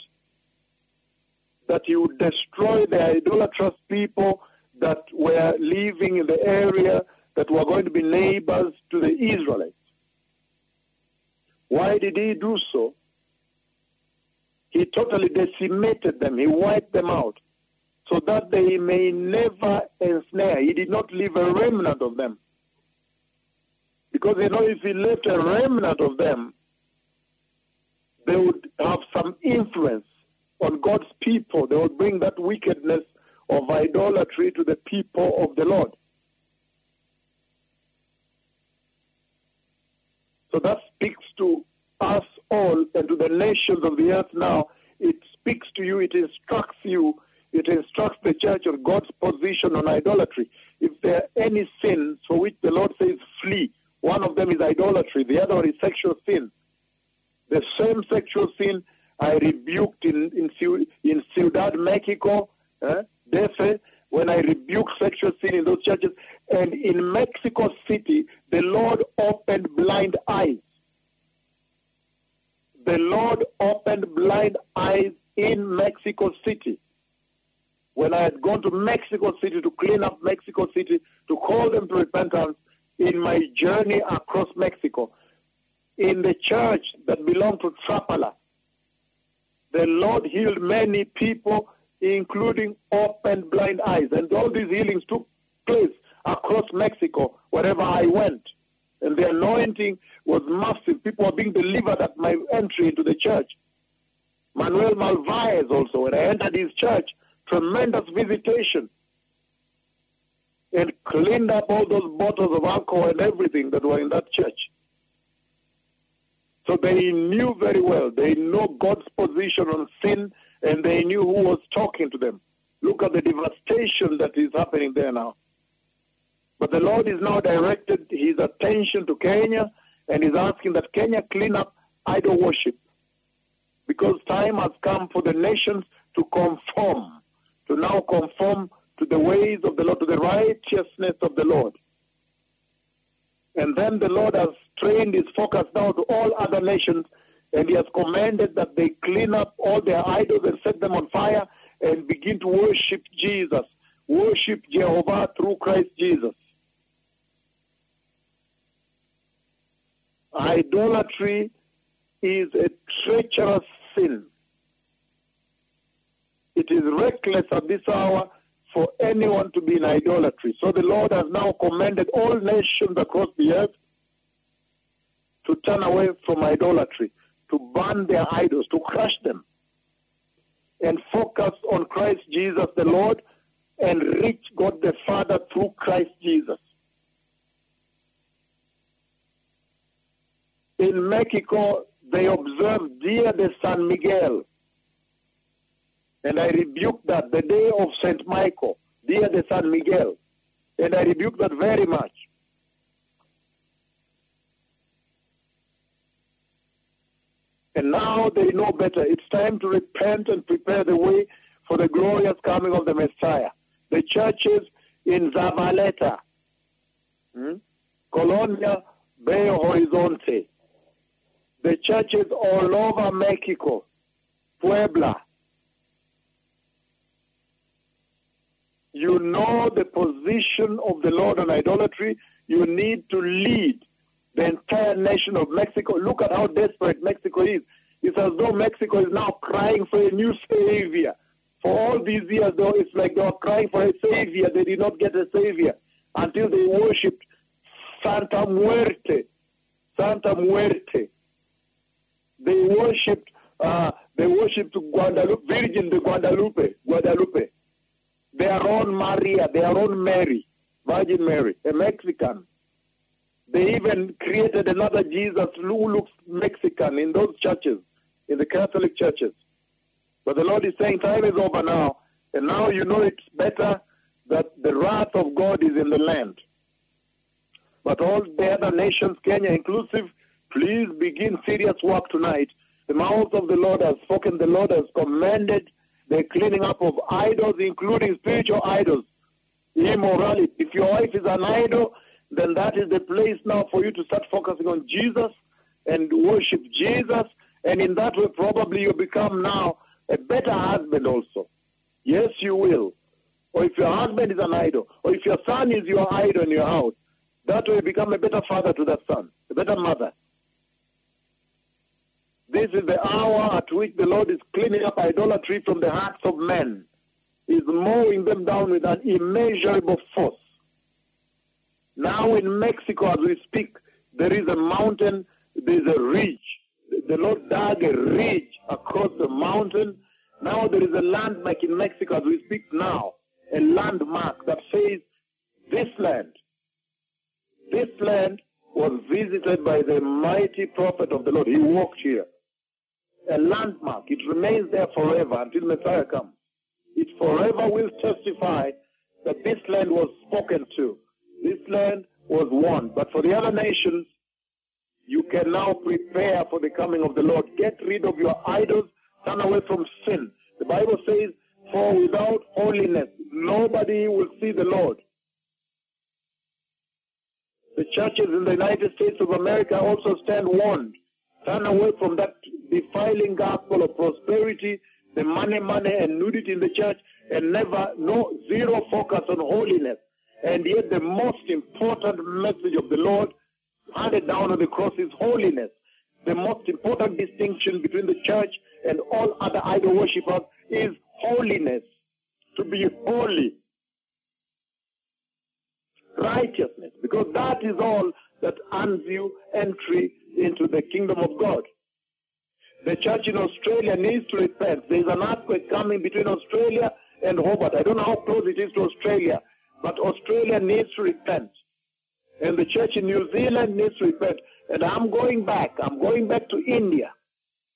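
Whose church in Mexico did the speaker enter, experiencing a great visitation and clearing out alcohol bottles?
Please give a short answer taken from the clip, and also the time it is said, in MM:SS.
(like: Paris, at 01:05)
Manuel Malvaez, at 01:44.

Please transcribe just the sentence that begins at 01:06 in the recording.
And in Mexico City, the Lord opened blind eyes.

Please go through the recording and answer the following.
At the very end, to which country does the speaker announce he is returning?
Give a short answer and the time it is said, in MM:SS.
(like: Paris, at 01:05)
India, at 06:56.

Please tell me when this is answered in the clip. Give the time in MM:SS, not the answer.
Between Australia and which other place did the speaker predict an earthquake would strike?
06:47.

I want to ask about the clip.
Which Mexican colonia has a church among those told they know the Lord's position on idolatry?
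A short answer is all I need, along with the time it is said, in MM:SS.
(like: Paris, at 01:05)
Colonia Belo Horizonte, at 03:38.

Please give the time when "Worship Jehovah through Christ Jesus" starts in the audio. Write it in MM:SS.
02:34.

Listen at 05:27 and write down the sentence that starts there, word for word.
The Lord dug a ridge across the mountain.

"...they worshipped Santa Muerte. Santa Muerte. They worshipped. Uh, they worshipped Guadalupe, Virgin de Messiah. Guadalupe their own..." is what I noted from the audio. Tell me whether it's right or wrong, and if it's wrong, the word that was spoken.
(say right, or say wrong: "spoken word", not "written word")
wrong: "Guadalupe", not "Messiah".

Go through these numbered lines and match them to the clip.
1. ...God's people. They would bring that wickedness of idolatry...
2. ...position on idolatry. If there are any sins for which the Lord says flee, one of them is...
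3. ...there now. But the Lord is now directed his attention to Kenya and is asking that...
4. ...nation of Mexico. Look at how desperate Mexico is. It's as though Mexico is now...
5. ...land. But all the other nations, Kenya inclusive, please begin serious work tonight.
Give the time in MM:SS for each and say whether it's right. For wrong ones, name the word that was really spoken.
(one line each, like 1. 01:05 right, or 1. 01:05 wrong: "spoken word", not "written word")
1. 00:30 right
2. 00:49 right
3. 02:04 right
4. 03:54 right
5. 04:35 right.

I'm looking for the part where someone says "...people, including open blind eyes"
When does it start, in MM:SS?
01:31.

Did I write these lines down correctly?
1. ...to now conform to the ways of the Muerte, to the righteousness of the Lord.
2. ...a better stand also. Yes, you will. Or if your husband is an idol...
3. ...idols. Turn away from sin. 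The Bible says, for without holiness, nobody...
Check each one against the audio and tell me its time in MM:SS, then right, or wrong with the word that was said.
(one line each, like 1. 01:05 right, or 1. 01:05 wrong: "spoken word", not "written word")
1. 02:17 wrong: "Lord", not "Muerte"
2. 05:00 wrong: "husband", not "stand"
3. 05:58 right.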